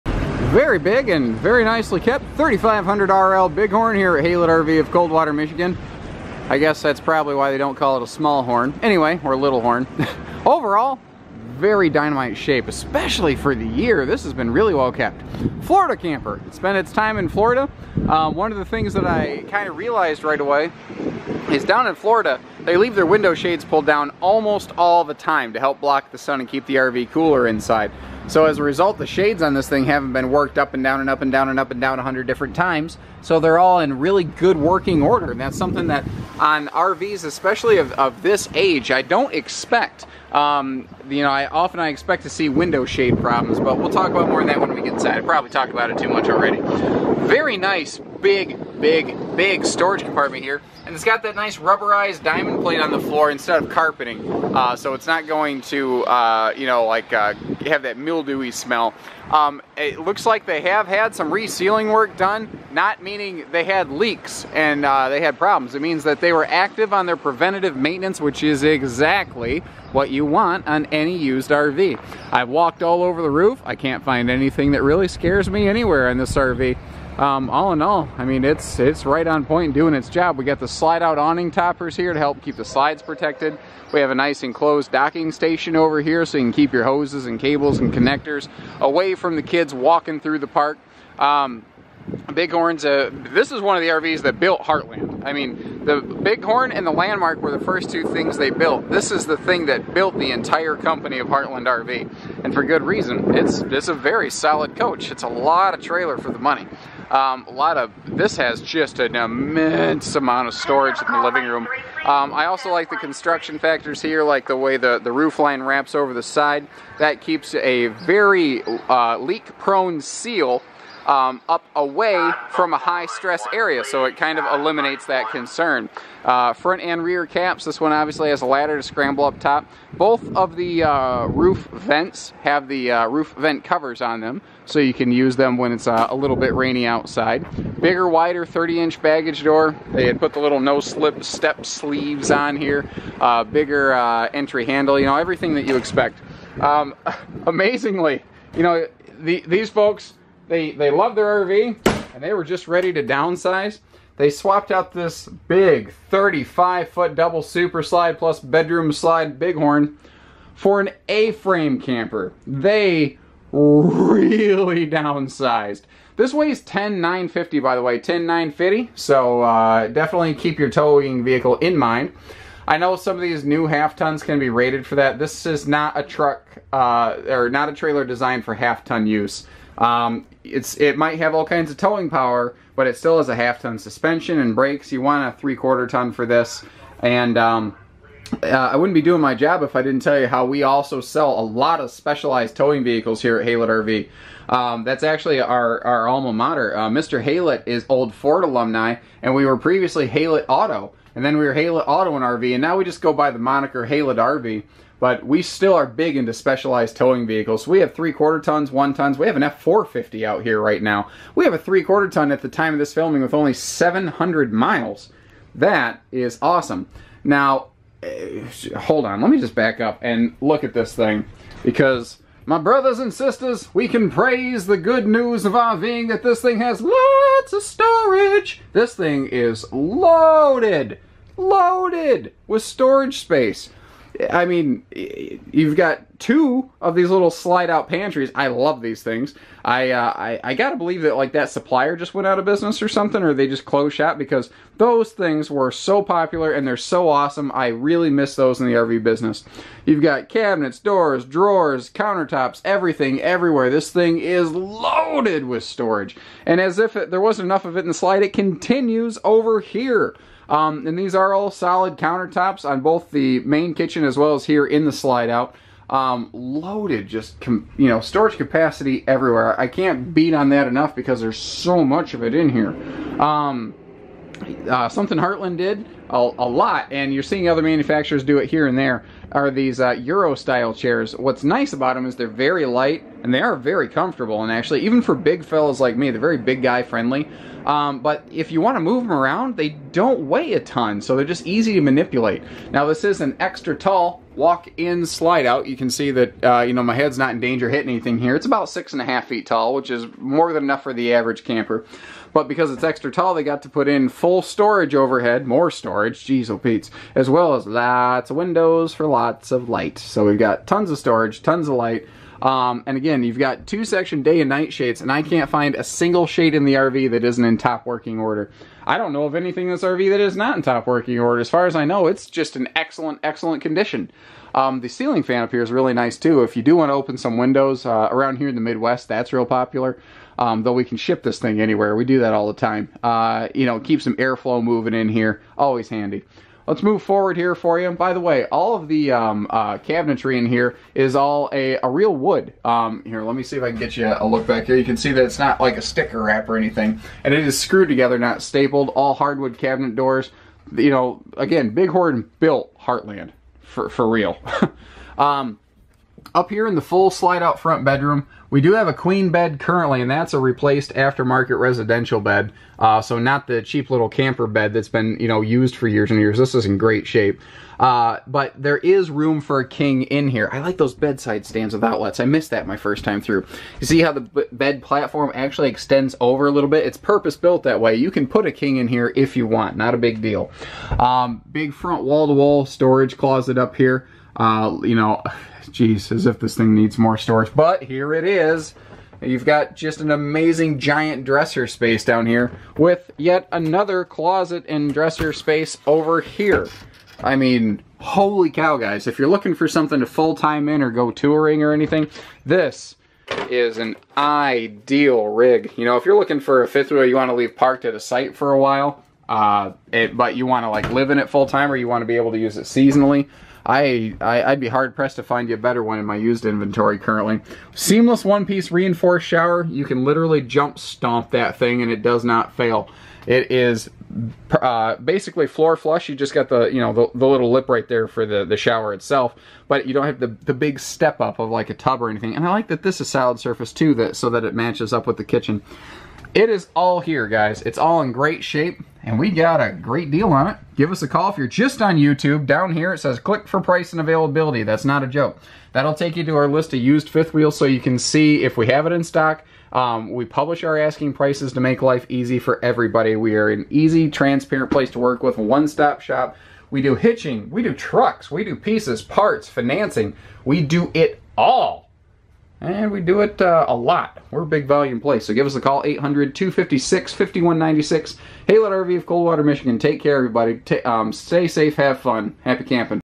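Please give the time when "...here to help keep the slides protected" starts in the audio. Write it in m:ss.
1:21.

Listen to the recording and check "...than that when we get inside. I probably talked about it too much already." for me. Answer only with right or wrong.
right.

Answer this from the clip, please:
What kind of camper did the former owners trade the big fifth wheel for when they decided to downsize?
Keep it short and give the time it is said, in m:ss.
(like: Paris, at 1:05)
A-frame camper, at 2:41.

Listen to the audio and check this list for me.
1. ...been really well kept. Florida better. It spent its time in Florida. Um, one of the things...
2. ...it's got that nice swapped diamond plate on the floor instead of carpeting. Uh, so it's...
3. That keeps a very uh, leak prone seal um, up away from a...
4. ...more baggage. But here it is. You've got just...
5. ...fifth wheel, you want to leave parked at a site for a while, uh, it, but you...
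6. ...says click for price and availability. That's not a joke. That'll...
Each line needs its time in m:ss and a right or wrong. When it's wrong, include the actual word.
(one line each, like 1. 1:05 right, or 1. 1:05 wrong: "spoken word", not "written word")
1. 0:14 wrong: "camper", not "better"
2. 0:50 wrong: "rubberized", not "swapped"
3. 1:56 right
4. 6:26 wrong: "storage", not "baggage"
5. 6:46 right
6. 7:22 right.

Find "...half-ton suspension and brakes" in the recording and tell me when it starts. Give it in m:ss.
3:03.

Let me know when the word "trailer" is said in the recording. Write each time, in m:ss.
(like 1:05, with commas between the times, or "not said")
1:45, 2:57.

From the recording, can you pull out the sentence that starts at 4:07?
I really miss those in the RV business.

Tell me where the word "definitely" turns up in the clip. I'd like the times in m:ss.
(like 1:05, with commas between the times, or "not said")
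2:49.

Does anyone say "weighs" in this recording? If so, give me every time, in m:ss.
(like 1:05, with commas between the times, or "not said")
2:46, 4:50.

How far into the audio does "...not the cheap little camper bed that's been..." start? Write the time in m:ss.
6:03.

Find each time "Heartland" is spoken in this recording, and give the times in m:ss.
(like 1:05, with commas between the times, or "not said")
1:34, 1:41, 4:35, 5:52.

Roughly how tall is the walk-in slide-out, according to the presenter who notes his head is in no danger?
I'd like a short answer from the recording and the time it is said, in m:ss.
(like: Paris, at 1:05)
six and a half feet, at 4:58.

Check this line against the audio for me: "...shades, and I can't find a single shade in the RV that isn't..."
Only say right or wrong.
right.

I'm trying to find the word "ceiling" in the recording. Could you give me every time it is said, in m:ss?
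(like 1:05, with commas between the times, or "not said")
5:24.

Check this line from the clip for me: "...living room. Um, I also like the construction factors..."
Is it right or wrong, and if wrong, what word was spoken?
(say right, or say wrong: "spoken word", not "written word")
right.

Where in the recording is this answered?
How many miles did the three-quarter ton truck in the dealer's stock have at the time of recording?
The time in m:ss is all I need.
3:33.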